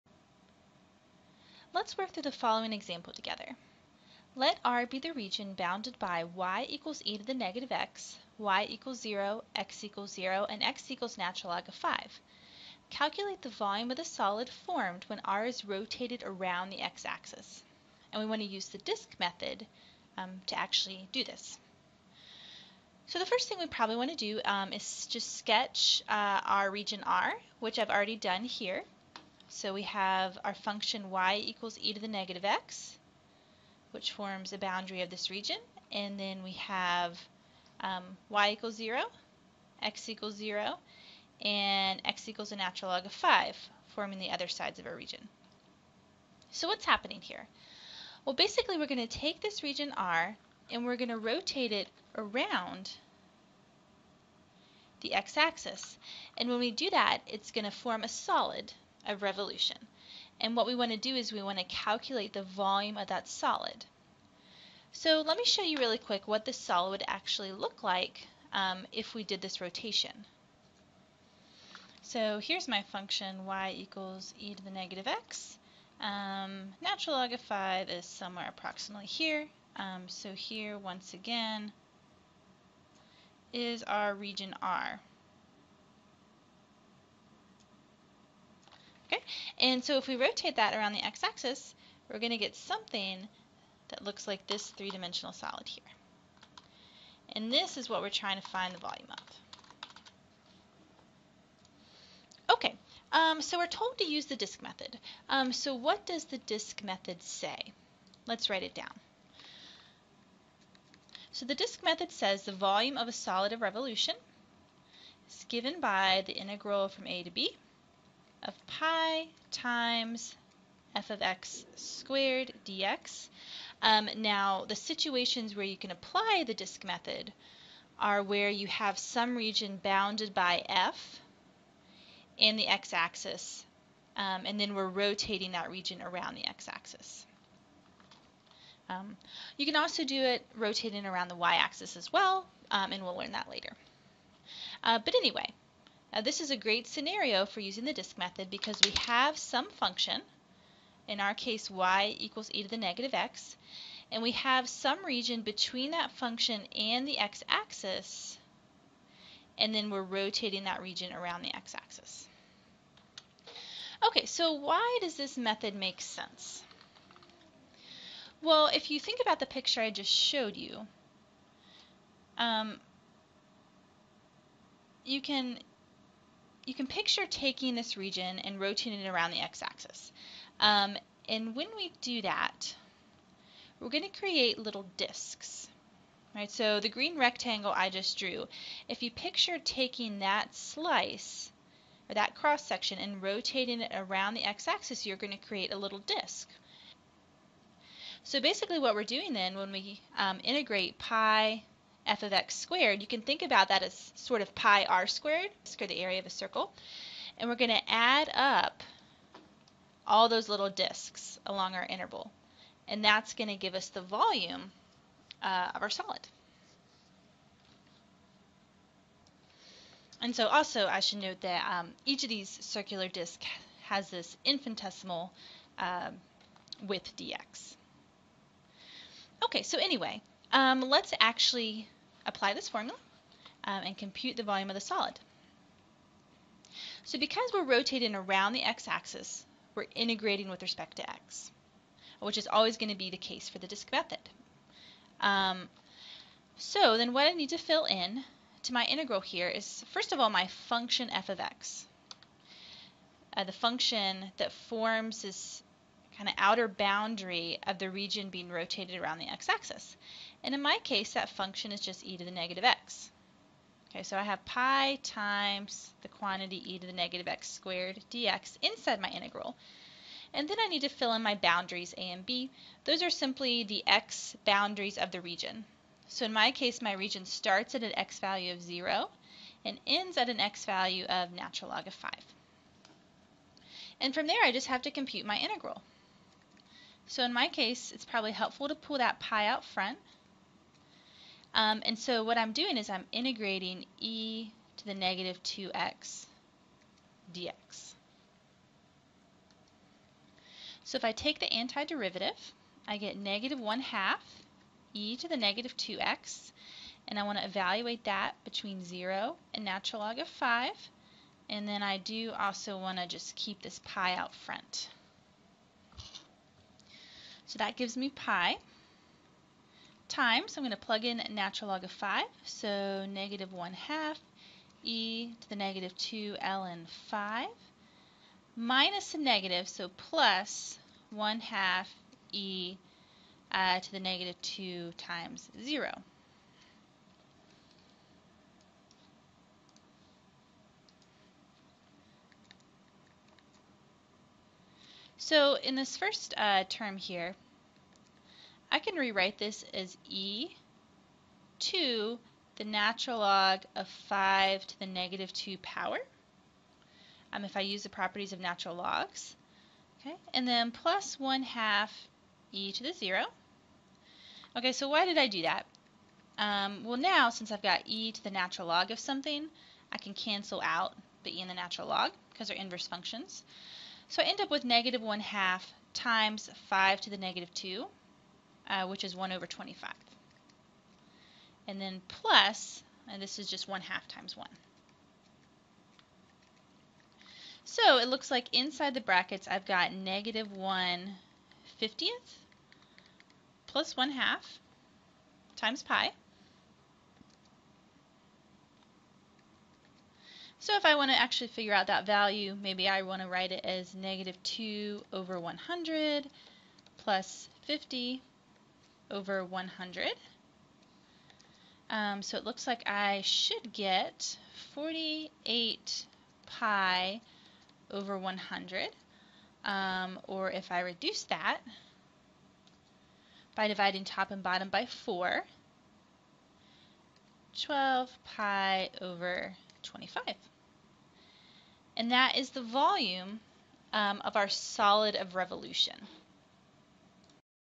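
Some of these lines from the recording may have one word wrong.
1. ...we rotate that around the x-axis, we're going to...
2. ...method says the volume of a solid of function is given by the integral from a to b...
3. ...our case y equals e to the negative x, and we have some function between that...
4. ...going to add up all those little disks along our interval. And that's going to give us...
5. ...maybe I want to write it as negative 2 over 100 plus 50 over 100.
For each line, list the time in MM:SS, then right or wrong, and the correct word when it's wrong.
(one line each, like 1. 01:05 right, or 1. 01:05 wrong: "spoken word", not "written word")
1. 01:30 right
2. 01:51 wrong: "revolution", not "function"
3. 02:31 wrong: "region", not "function"
4. 03:27 right
5. 06:42 right.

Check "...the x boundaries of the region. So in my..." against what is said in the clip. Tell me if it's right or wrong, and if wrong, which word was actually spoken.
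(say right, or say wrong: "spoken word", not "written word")
right.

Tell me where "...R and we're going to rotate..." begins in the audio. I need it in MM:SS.
00:49.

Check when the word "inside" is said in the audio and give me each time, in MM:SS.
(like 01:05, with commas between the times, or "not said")
04:28, 06:28.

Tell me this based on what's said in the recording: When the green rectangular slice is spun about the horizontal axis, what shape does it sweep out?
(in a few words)
A little disk.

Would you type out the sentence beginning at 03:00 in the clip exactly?
Um, and when we do that, we're going to create little disks.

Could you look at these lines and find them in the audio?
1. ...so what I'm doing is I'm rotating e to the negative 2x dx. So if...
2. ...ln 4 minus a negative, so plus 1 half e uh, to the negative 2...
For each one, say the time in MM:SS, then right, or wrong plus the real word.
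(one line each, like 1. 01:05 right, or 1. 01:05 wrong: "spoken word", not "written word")
1. 04:51 wrong: "integrating", not "rotating"
2. 05:26 wrong: "5", not "4".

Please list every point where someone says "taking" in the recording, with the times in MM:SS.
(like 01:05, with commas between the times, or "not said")
02:57, 03:09.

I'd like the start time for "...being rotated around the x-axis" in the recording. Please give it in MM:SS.
04:18.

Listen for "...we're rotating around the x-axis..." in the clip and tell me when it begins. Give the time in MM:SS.
03:57.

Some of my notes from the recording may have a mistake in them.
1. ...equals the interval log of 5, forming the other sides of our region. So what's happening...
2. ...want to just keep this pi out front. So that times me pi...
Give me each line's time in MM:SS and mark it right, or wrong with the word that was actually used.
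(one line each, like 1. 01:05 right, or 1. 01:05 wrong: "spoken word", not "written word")
1. 00:42 wrong: "natural", not "interval"
2. 05:12 wrong: "gives", not "times".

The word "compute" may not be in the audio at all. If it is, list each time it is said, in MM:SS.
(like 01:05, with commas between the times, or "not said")
03:53, 04:44.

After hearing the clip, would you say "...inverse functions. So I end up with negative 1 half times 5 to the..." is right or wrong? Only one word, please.
right.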